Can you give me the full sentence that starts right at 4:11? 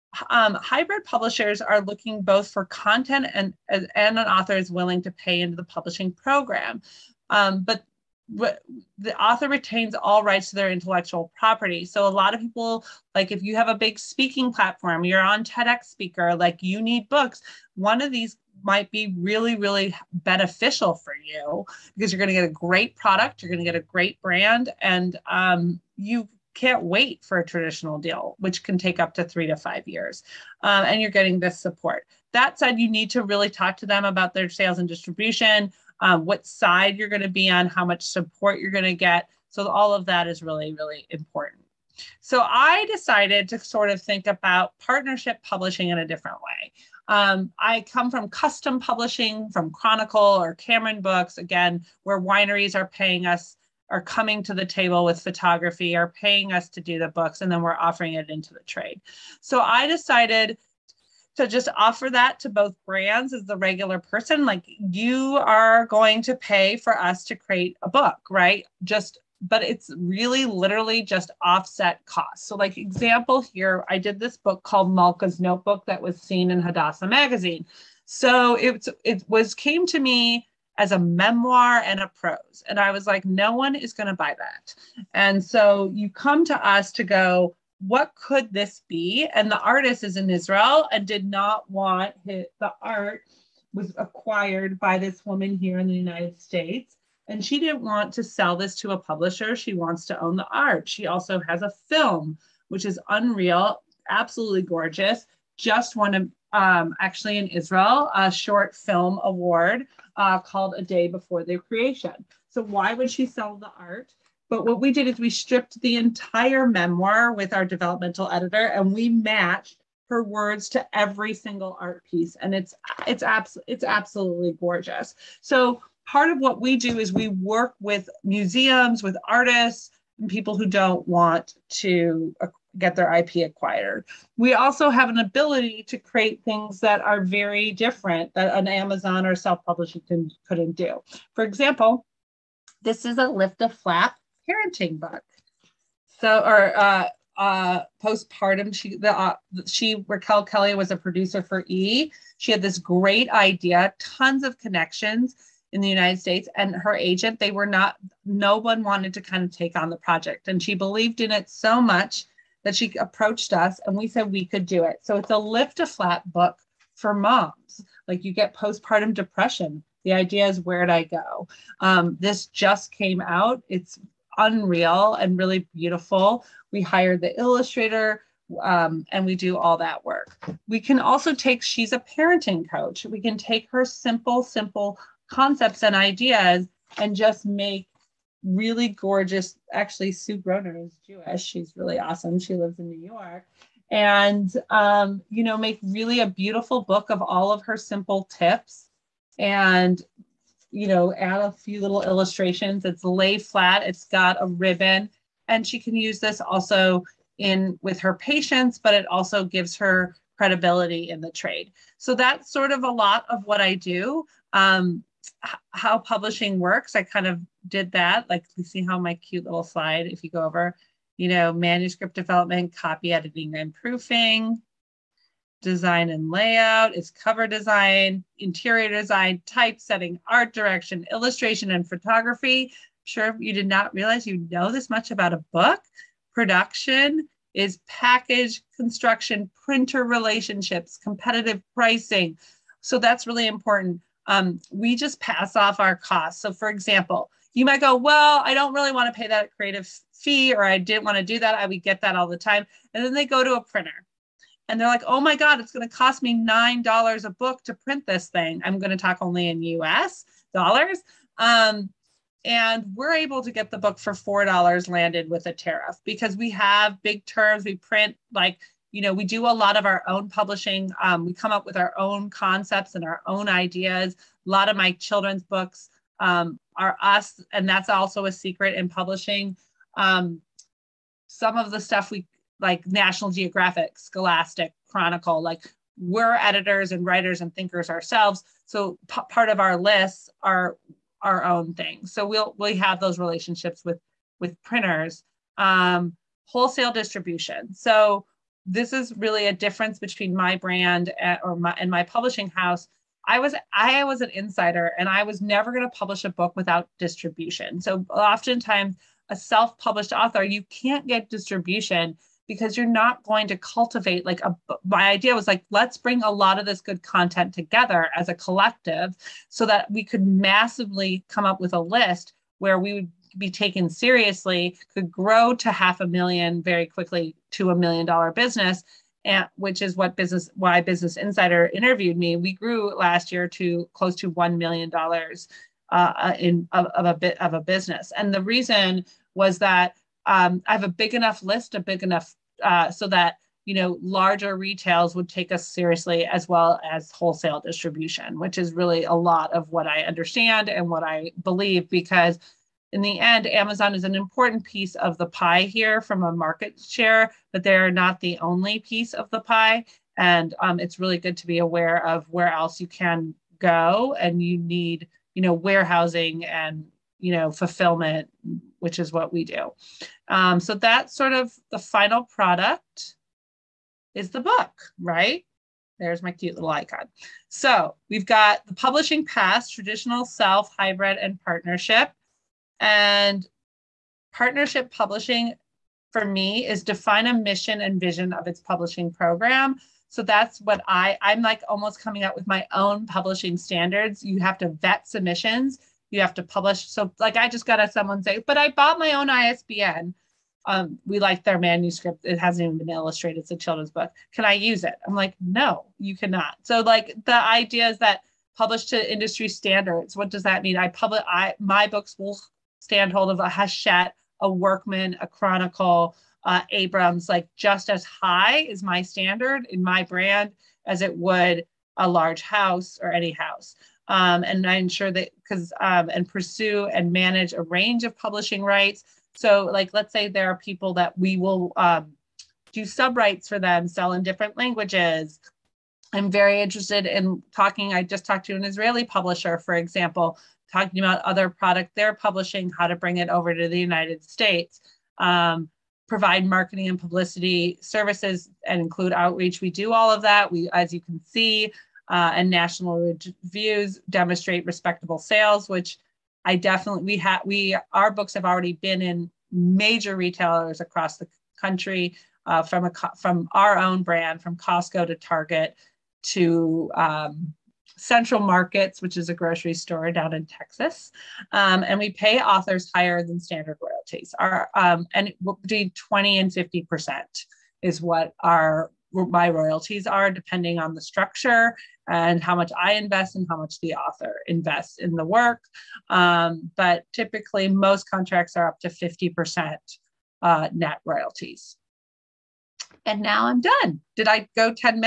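I would get that all the time.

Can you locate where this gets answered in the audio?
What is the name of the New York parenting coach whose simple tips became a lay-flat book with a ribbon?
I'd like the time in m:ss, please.
3:10.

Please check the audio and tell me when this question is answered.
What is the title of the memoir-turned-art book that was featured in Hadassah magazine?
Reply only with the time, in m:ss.
1:14.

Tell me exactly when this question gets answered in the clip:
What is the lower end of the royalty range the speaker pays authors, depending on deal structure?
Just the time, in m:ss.
7:55.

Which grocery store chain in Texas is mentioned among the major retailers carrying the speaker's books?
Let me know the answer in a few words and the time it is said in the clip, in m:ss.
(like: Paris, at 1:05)
Central Markets, at 7:47.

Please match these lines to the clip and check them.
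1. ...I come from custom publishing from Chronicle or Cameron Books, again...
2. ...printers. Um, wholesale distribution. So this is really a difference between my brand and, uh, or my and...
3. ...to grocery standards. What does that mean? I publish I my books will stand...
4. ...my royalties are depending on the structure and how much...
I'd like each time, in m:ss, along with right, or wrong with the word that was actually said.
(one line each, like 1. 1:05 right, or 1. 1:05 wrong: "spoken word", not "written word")
1. 0:47 right
2. 4:54 right
3. 6:48 wrong: "industry", not "grocery"
4. 7:59 right.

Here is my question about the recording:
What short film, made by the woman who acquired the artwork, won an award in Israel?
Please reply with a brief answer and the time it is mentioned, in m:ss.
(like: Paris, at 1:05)
A Day Before the Creation, at 1:50.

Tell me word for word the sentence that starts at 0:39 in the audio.
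So all of that is really, really important.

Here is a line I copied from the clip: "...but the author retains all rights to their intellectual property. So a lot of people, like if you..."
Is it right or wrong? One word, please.
right.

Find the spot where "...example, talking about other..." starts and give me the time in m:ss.
7:19.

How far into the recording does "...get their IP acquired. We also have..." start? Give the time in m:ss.
2:12.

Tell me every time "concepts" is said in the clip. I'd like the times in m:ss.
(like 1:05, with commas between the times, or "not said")
3:05, 4:32.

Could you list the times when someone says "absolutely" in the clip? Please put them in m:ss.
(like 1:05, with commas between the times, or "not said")
1:44, 2:03.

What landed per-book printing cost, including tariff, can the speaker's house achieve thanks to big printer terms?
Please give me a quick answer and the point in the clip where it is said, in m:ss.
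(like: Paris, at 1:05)
$4, at 4:24.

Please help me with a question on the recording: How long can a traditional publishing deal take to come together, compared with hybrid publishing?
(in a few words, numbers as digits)
3 to 5 years.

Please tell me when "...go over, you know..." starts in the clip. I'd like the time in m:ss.
3:40.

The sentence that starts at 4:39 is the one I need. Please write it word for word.
Um, some of the stuff we like National Geographic, Scholastic, Chronicle, like we're editors and writers and thinkers ourselves.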